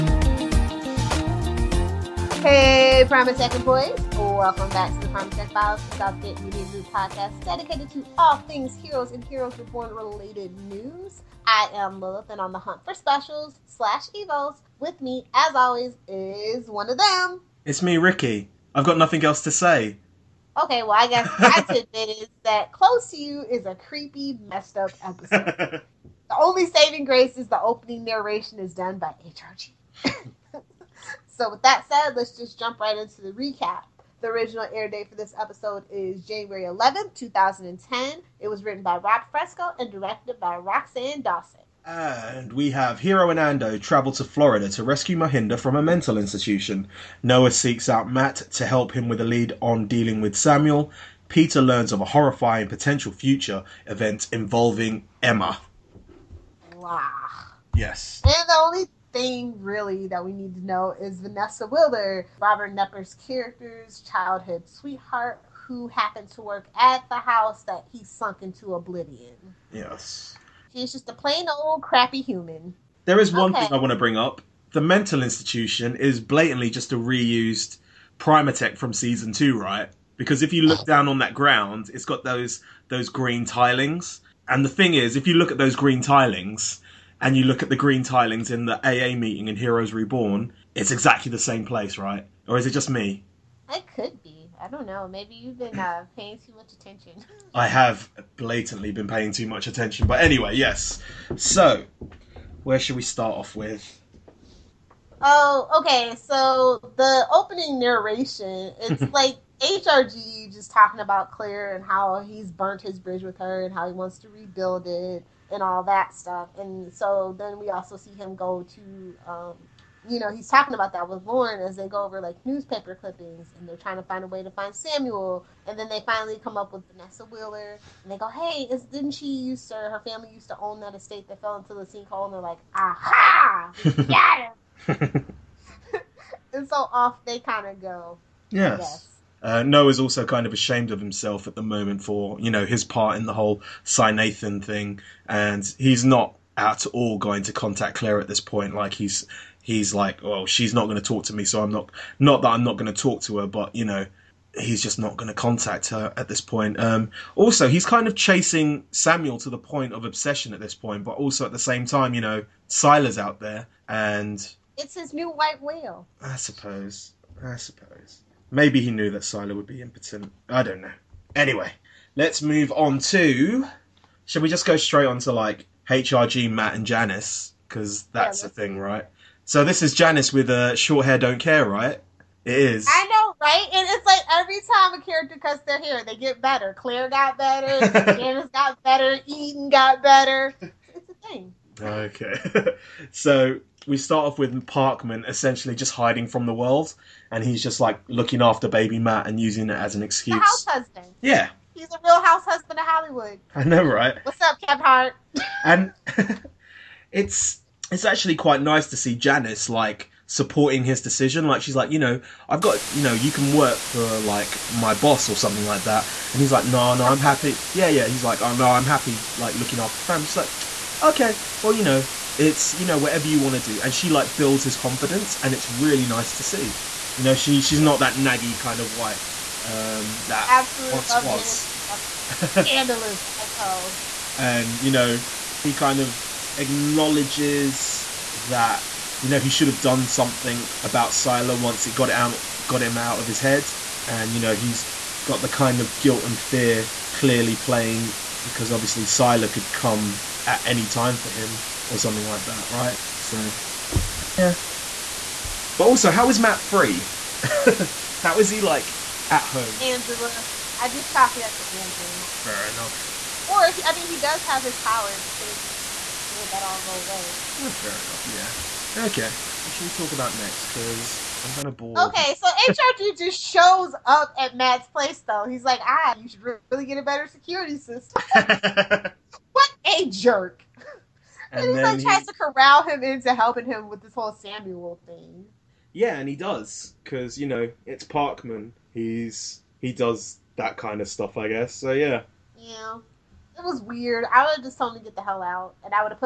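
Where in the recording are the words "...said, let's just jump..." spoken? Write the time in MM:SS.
00:31.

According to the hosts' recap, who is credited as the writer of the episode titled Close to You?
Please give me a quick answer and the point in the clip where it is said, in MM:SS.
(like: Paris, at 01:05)
Rob Fresco, at 00:38.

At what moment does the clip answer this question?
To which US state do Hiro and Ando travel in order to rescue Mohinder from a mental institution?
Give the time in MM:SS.
00:44.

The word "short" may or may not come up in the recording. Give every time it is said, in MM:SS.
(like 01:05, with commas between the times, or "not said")
03:00.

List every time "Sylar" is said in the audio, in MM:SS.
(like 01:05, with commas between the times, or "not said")
02:42, 02:49, 04:01, 04:09.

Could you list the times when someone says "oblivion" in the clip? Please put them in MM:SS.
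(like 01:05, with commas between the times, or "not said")
01:08.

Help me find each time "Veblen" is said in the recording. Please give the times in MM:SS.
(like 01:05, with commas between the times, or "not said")
not said.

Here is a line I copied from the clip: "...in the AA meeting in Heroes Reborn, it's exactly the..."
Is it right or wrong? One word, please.
right.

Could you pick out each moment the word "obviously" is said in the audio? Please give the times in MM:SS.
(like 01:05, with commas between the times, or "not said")
04:08.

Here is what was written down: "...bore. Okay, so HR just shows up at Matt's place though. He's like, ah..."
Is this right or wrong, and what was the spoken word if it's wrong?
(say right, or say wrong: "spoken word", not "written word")
right.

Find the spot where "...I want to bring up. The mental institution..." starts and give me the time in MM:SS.
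01:13.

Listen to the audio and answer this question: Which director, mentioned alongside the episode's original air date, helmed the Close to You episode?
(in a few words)
Roxann Dawson.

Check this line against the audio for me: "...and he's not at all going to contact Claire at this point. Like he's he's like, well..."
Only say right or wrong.
right.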